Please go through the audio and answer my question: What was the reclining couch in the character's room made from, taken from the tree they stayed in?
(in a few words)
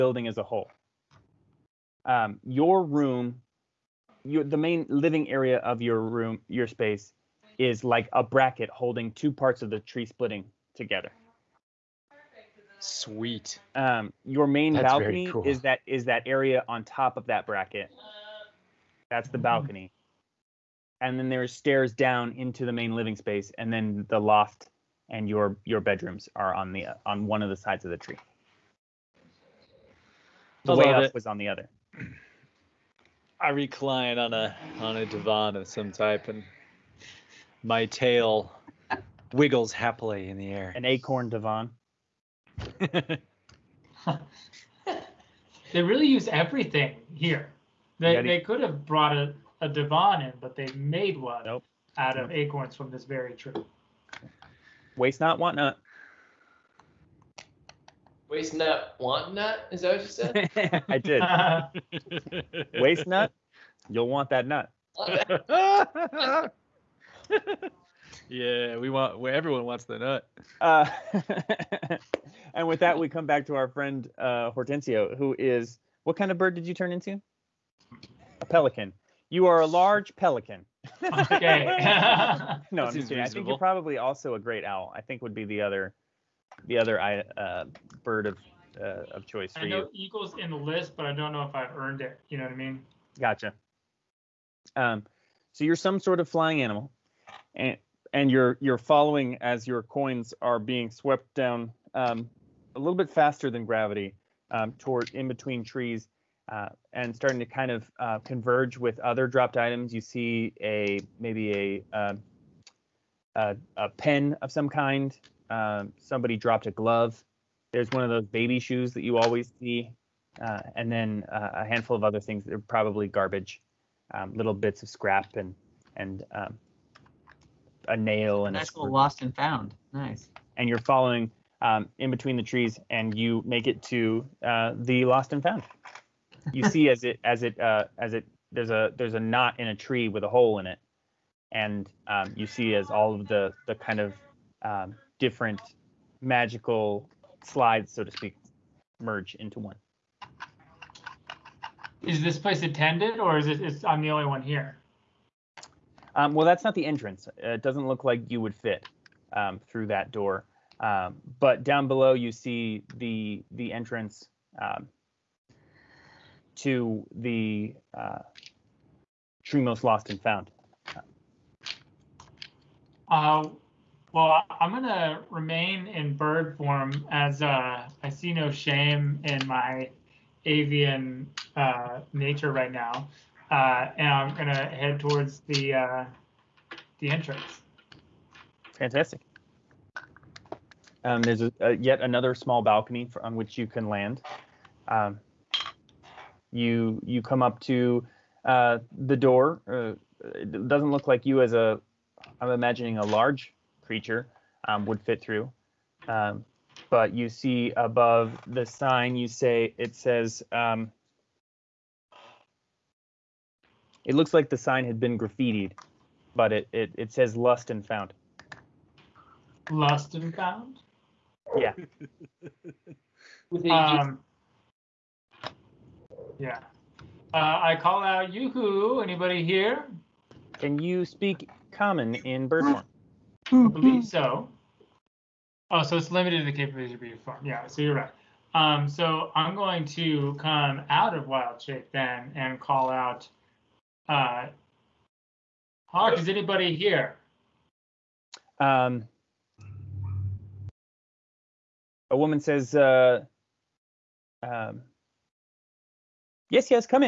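Acorns.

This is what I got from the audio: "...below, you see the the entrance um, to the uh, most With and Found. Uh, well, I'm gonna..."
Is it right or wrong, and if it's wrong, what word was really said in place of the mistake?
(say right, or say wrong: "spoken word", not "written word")
wrong: "Lost", not "With".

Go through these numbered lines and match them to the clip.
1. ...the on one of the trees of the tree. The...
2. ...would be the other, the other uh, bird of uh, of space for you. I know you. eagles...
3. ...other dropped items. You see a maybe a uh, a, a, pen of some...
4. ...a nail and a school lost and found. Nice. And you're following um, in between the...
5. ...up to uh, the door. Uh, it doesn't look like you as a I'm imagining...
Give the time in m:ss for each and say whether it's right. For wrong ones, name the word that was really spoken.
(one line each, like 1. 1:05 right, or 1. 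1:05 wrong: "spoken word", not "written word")
1. 0:26 wrong: "sides", not "trees"
2. 1:25 wrong: "choice", not "space"
3. 1:49 right
4. 2:07 right
5. 3:17 right.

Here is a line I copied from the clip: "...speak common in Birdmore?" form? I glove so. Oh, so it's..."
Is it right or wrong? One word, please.
wrong.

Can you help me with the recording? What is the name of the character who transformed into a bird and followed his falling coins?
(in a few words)
Hortensio.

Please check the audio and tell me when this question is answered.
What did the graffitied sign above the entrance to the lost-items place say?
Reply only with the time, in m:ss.
3:37.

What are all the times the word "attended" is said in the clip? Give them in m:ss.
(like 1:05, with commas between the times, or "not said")
2:32.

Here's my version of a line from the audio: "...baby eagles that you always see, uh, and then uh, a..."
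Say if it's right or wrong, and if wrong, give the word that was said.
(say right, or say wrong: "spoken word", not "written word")
wrong: "shoes", not "eagles".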